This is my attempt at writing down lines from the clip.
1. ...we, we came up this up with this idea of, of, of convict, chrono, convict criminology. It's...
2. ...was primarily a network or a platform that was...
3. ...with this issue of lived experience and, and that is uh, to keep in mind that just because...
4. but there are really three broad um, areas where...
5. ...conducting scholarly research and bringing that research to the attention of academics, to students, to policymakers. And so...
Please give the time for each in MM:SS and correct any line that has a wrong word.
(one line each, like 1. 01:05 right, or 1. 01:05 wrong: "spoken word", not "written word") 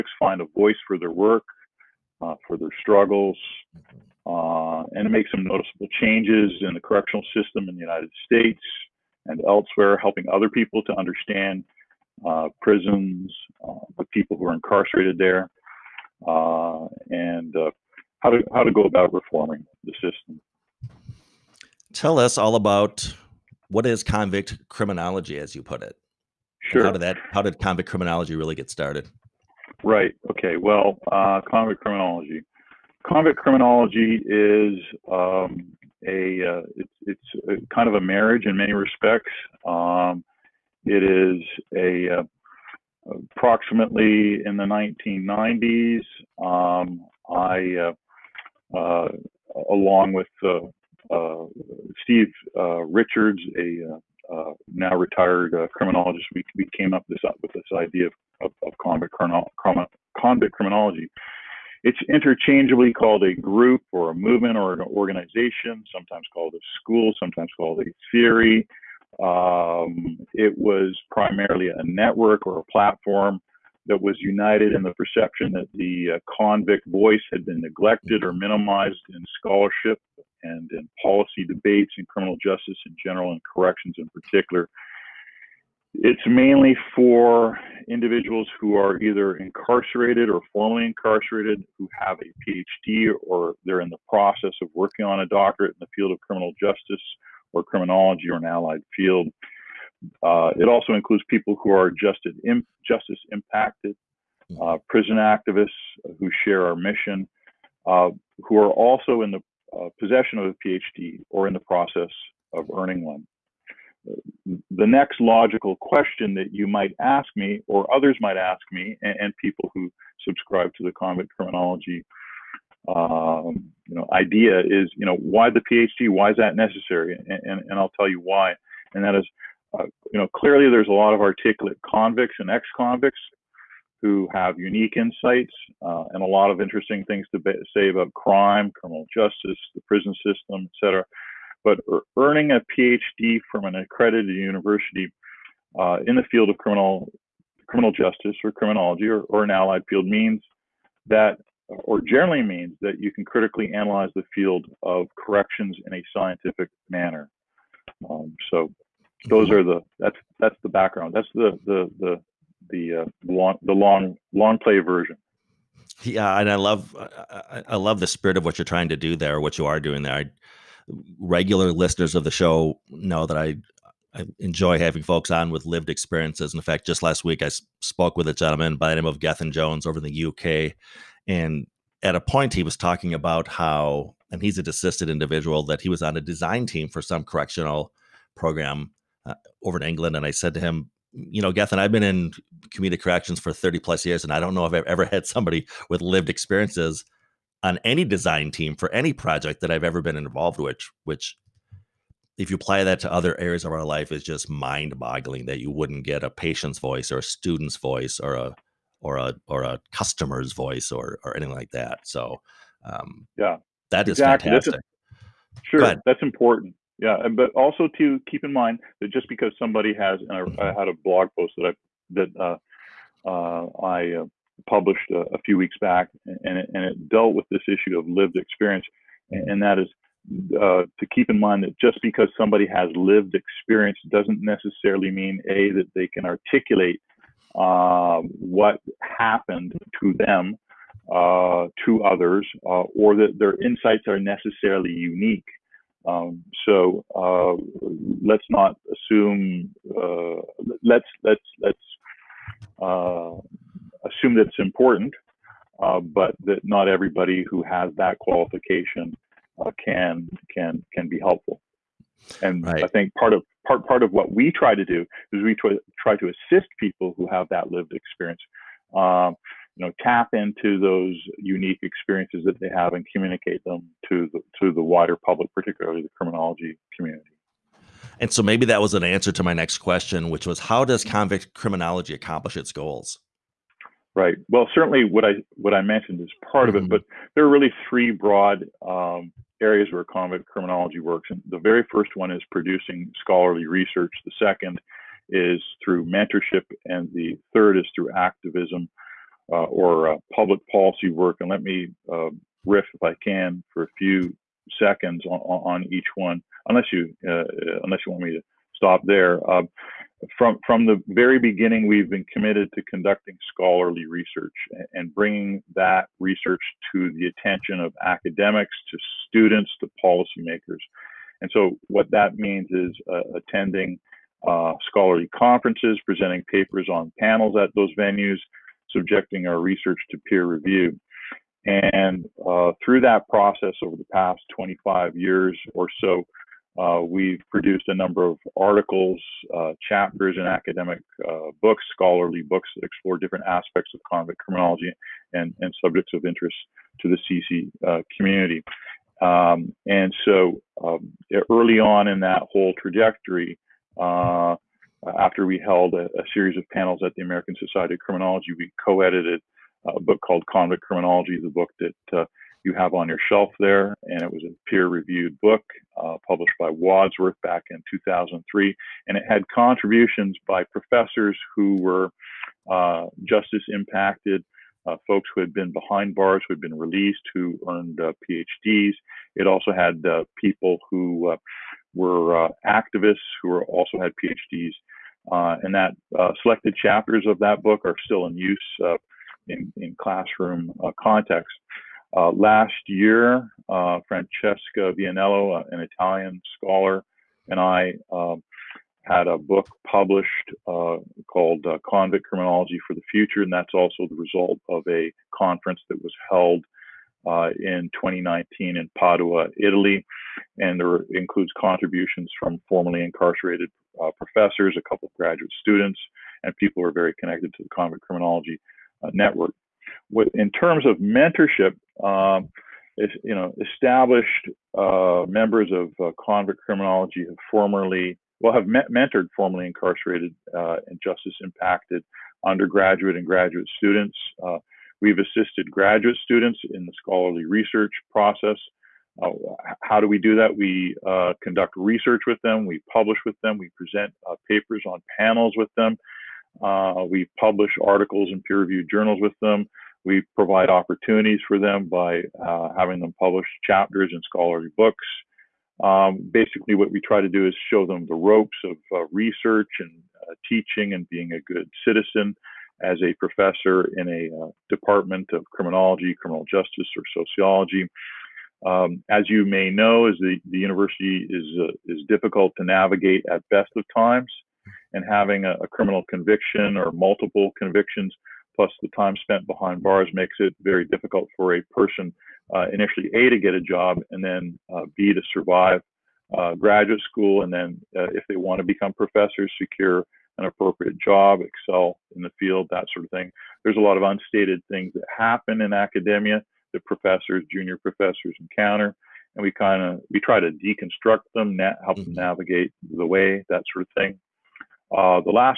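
1. 00:56 right
2. 01:10 right
3. 03:47 right
4. 04:46 right
5. 05:12 right.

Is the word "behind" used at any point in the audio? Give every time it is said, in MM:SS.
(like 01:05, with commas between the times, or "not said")
06:15, 07:59.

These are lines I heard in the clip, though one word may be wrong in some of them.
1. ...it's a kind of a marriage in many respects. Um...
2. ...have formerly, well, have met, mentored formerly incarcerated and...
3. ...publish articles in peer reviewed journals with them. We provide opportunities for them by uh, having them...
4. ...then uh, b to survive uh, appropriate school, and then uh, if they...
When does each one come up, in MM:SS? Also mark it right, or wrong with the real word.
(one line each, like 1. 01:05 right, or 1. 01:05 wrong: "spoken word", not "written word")
1. 00:37 right
2. 07:07 right
3. 07:27 right
4. 08:04 wrong: "graduate", not "appropriate".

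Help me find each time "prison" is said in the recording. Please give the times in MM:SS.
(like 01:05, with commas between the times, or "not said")
00:12, 01:44, 02:19.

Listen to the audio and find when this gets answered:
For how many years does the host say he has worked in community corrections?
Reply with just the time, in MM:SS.
03:13.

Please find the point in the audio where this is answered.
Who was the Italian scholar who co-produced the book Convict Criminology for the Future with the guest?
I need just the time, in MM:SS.
06:34.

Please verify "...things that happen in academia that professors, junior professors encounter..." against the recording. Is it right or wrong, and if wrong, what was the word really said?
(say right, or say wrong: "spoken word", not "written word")
right.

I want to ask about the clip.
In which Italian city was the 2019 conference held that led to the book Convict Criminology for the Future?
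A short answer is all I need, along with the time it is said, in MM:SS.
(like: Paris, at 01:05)
Padua, at 06:48.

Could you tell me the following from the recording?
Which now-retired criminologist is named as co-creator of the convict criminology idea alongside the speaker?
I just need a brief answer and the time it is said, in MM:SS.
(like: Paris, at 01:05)
Steve Richards, at 00:52.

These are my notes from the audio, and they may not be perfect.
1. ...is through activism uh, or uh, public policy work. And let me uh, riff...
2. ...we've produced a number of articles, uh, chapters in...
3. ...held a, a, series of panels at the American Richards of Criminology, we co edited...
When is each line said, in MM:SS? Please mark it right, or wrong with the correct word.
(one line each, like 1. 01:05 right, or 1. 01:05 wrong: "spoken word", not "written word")
1. 04:57 right
2. 05:37 right
3. 05:55 wrong: "Society", not "Richards".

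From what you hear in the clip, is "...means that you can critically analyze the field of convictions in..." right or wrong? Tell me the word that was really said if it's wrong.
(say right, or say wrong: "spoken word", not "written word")
wrong: "corrections", not "convictions".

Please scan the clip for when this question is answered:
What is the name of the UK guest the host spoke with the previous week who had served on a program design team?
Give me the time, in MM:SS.
02:59.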